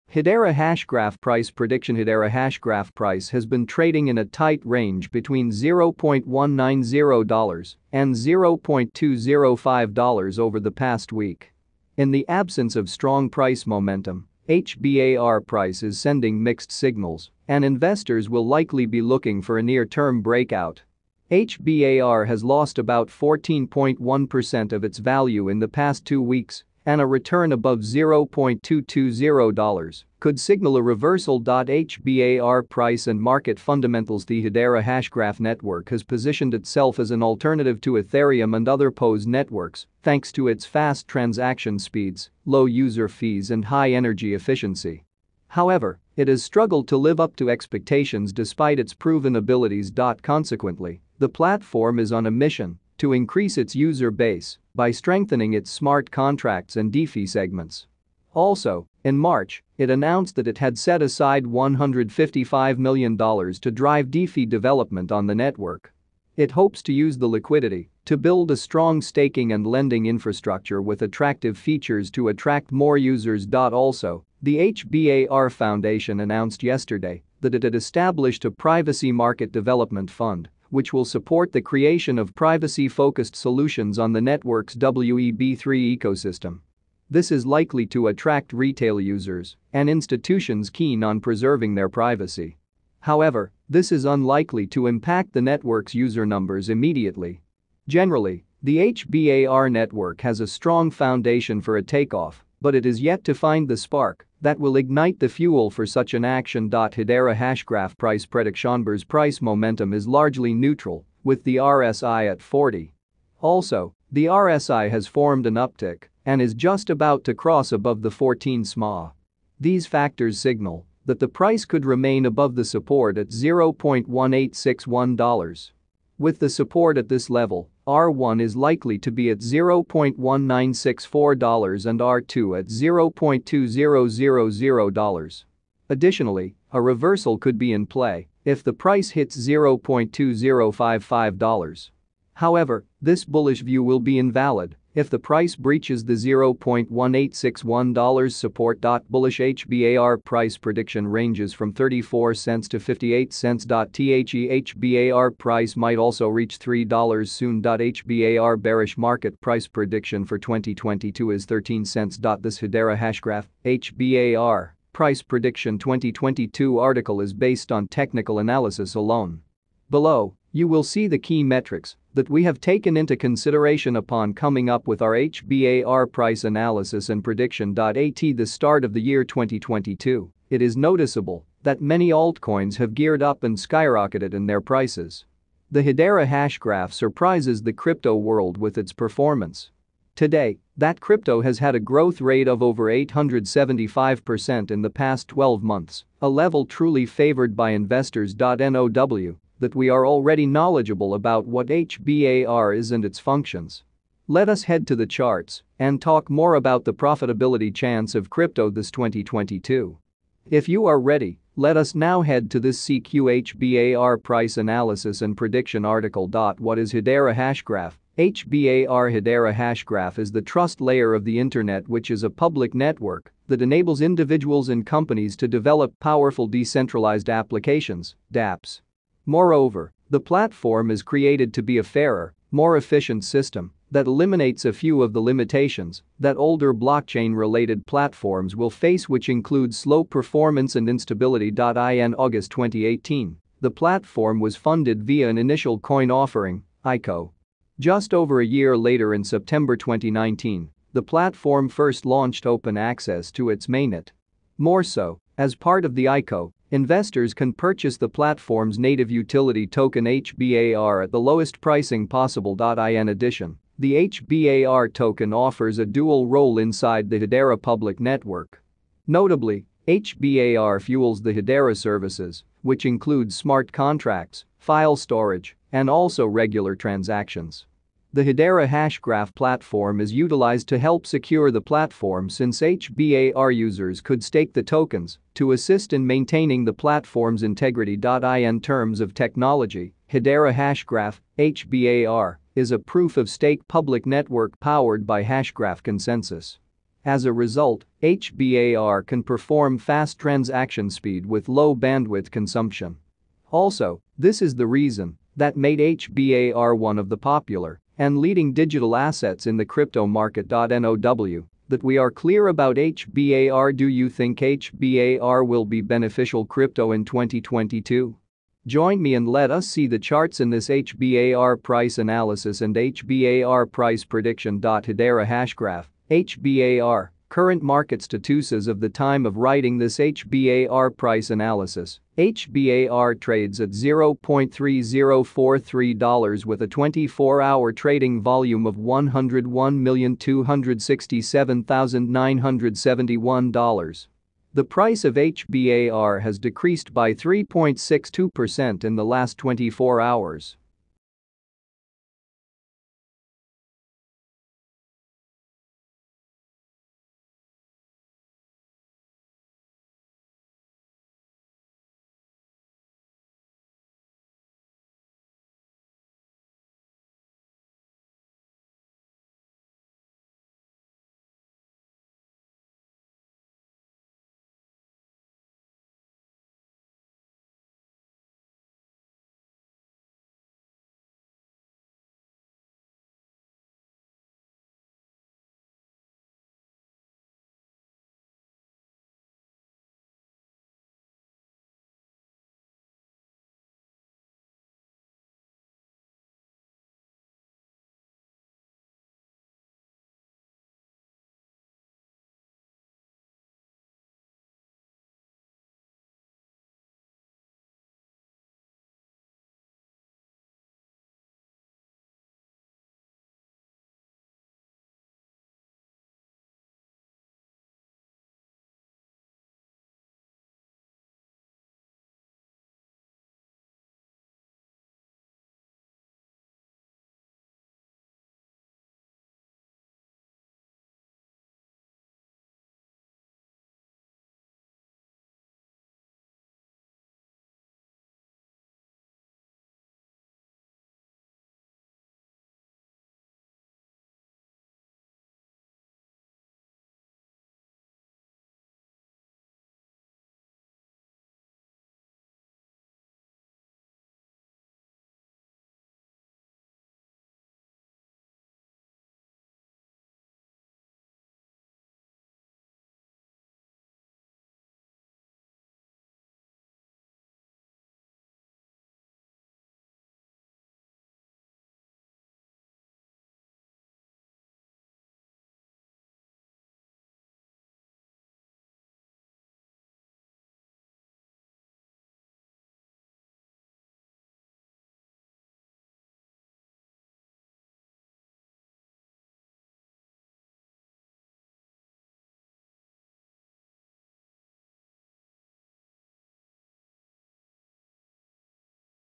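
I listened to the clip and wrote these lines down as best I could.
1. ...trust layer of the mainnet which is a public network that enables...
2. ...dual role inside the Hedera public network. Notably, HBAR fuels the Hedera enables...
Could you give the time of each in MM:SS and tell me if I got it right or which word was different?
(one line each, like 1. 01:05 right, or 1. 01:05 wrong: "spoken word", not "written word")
1. 03:40 wrong: "internet", not "mainnet"
2. 04:25 wrong: "services", not "enables".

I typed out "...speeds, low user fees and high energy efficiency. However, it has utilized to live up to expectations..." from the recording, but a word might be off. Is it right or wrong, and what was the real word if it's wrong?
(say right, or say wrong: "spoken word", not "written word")
wrong: "struggled", not "utilized".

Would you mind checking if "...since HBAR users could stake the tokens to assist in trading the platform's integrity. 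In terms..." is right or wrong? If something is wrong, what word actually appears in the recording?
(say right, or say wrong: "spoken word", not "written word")
wrong: "maintaining", not "trading".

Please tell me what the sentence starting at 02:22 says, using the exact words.
However, this bullish view will be invalid if the price breaches the $0.1861 support.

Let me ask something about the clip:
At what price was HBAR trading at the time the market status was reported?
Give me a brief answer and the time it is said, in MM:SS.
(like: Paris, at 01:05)
$0.3043, at 05:33.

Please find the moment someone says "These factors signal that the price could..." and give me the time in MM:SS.
01:59.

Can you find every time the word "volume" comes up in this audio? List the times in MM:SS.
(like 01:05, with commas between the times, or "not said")
05:38.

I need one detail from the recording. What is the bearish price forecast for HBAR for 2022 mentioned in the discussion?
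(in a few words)
13 cents.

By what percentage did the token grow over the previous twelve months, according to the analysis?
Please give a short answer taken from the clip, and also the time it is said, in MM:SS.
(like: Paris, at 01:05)
875%, at 03:12.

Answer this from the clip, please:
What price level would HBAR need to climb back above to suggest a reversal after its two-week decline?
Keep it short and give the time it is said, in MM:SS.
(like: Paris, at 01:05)
$0.220, at 00:27.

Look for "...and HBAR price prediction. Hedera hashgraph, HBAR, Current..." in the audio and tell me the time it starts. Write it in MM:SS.
05:22.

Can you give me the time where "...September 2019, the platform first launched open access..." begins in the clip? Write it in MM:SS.
04:09.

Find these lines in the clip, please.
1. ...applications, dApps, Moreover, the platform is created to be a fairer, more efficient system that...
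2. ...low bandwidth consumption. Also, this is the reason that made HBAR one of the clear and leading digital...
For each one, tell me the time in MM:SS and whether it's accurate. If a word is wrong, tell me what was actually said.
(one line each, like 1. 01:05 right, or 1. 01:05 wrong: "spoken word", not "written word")
1. 03:47 right
2. 05:01 wrong: "popular", not "clear".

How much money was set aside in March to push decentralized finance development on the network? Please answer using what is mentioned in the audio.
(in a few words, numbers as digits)
$155 million.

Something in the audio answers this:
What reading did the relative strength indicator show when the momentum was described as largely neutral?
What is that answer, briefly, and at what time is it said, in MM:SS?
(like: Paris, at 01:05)
40, at 01:52.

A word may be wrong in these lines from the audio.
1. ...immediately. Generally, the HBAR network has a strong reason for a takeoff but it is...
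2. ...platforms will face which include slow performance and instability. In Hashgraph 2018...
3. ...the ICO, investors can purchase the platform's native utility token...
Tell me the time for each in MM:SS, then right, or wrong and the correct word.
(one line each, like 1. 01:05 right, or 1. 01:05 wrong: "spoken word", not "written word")
1. 01:36 wrong: "foundation", not "reason"
2. 03:57 wrong: "August", not "Hashgraph"
3. 04:15 right.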